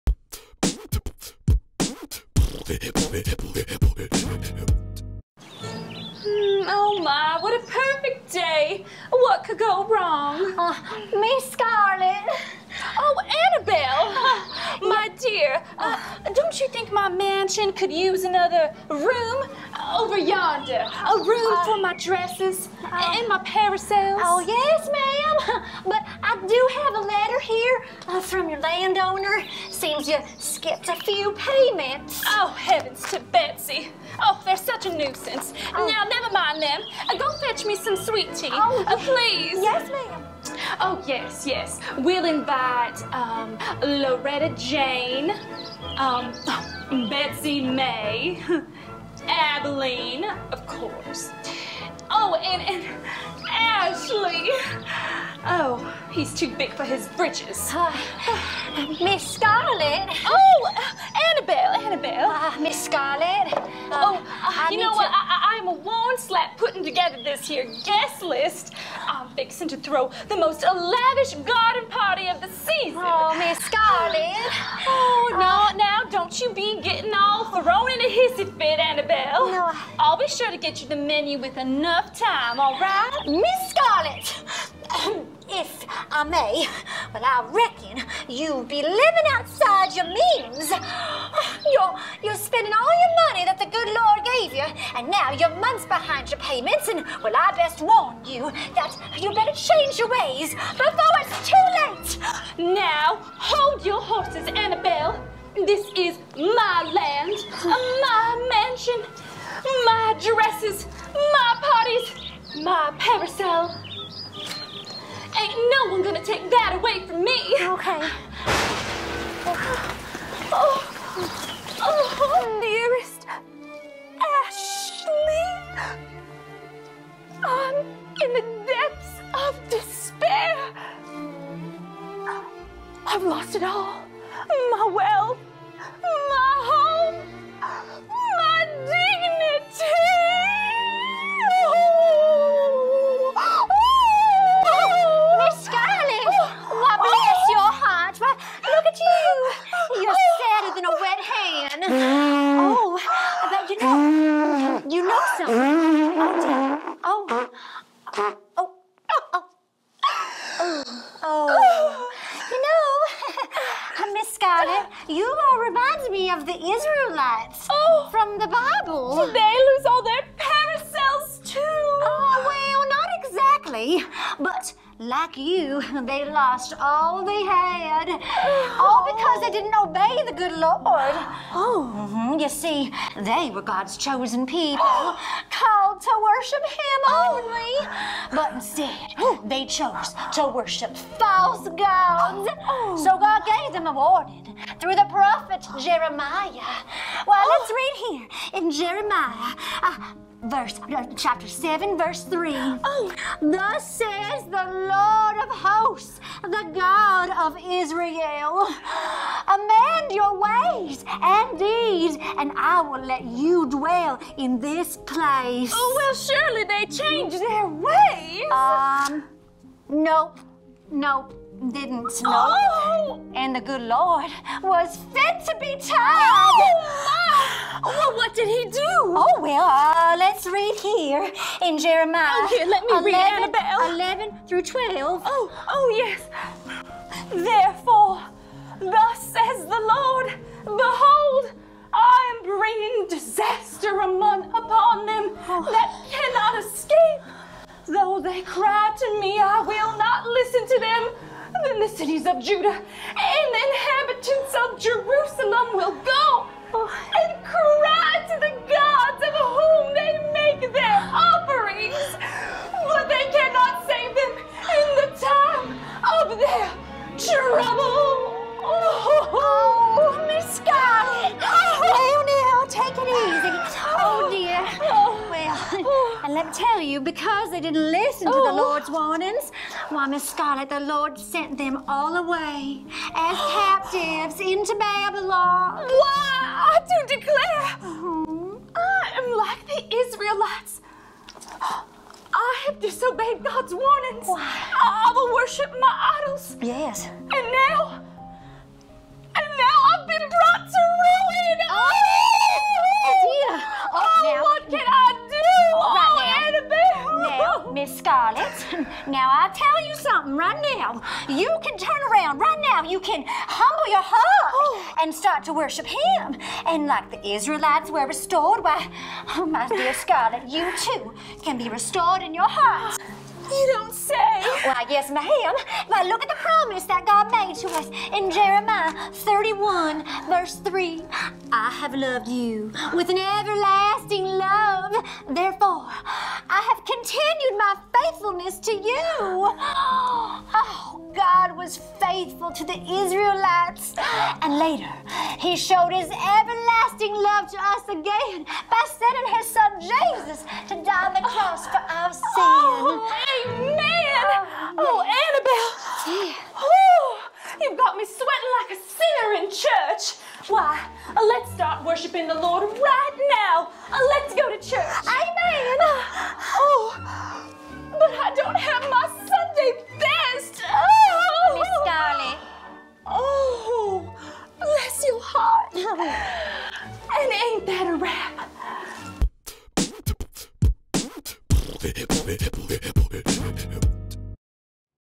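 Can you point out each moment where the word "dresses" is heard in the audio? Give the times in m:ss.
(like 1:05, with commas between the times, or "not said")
0:21, 1:50.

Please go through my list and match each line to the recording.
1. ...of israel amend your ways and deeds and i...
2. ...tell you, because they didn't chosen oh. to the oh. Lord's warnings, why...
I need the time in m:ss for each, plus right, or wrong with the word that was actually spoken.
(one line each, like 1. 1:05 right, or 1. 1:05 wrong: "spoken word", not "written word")
1. 3:27 right
2. 4:36 wrong: "listen", not "chosen".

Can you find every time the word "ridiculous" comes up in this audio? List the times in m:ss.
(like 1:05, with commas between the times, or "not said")
not said.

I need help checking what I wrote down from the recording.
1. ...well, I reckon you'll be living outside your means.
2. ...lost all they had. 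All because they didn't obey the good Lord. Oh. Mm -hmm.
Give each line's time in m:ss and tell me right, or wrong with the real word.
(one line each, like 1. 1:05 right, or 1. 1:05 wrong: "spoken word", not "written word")
1. 1:27 right
2. 2:56 right.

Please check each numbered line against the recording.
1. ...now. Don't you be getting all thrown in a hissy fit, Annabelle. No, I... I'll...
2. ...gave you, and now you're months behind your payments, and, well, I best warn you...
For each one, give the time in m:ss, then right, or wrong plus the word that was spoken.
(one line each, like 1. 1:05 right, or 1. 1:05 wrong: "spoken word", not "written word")
1. 1:15 right
2. 1:34 right.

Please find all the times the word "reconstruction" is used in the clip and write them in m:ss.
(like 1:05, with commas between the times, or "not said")
not said.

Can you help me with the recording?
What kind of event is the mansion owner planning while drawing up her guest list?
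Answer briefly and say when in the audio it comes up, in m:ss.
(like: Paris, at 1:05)
garden party, at 1:11.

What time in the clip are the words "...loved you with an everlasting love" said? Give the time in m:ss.
5:31.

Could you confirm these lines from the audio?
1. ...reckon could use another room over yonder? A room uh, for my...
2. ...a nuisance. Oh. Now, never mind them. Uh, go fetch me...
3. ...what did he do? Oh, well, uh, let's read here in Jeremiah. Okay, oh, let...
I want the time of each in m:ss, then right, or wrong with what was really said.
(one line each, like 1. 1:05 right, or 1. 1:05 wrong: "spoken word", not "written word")
1. 0:17 wrong: "mansion", not "reckon"
2. 0:34 right
3. 3:48 right.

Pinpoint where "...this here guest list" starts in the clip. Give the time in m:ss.
1:07.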